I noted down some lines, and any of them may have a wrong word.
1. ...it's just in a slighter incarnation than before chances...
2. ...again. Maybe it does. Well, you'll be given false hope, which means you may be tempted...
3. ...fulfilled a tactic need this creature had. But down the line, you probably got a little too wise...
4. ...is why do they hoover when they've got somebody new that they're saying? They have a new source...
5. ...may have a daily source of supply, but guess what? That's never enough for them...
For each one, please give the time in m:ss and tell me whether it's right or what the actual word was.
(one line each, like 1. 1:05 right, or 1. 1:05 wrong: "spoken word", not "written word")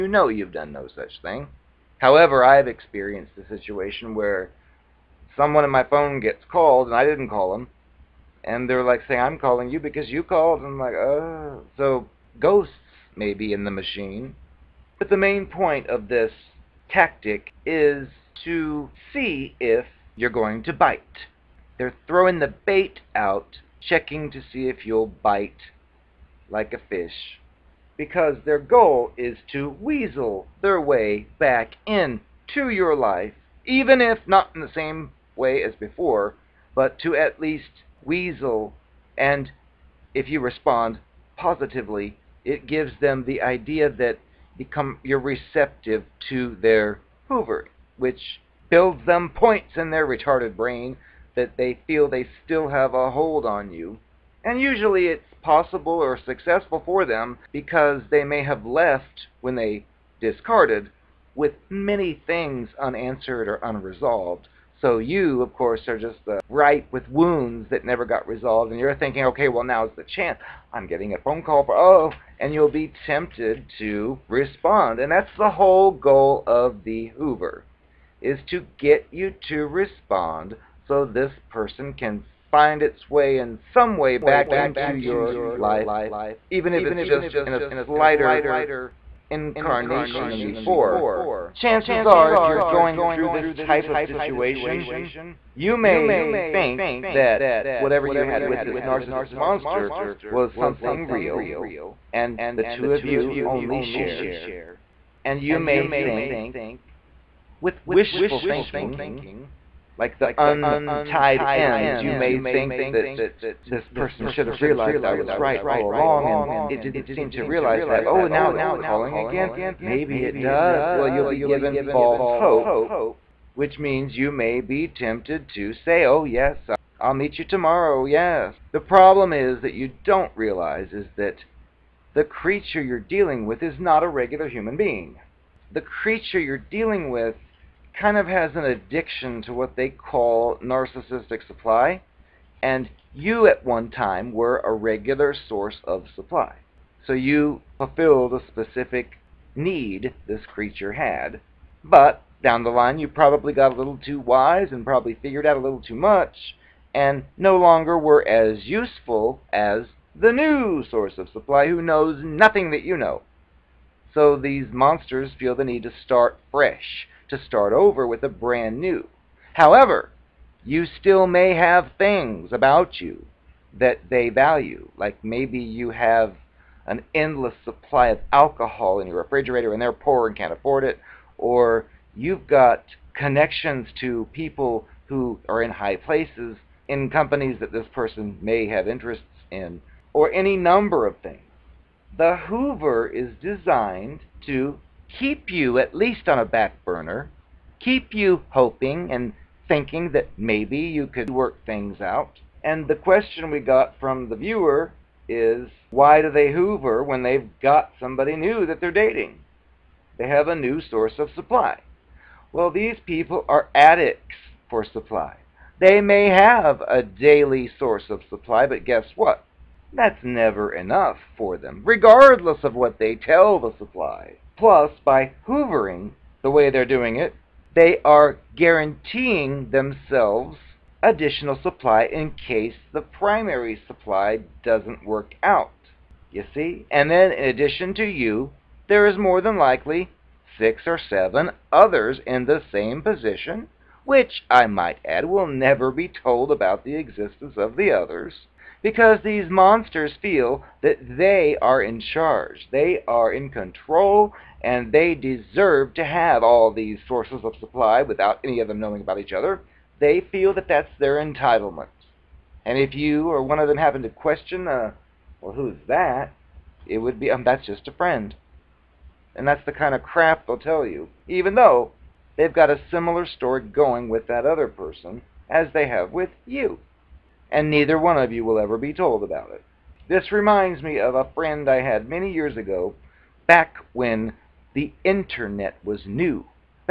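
1. 1:26 right
2. 1:59 right
3. 2:27 wrong: "specific", not "tactic"
4. 3:25 wrong: "dating", not "saying"
5. 3:36 right.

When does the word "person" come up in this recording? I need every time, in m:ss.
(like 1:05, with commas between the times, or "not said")
1:21, 1:53, 3:07, 4:34.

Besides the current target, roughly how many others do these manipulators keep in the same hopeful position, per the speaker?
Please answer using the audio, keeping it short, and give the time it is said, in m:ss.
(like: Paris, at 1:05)
6 or 7, at 4:00.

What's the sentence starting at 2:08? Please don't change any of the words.
The problem is that you don't realize is that the creature you're dealing with is not a regular human being.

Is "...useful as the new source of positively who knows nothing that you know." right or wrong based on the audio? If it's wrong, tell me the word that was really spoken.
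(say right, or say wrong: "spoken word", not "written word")
wrong: "supply", not "positively".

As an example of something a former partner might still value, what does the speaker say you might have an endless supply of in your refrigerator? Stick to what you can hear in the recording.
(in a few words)
alcohol.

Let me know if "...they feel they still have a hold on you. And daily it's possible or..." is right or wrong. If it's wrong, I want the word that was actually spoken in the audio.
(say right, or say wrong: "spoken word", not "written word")
wrong: "usually", not "daily".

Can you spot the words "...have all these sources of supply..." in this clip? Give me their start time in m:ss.
4:16.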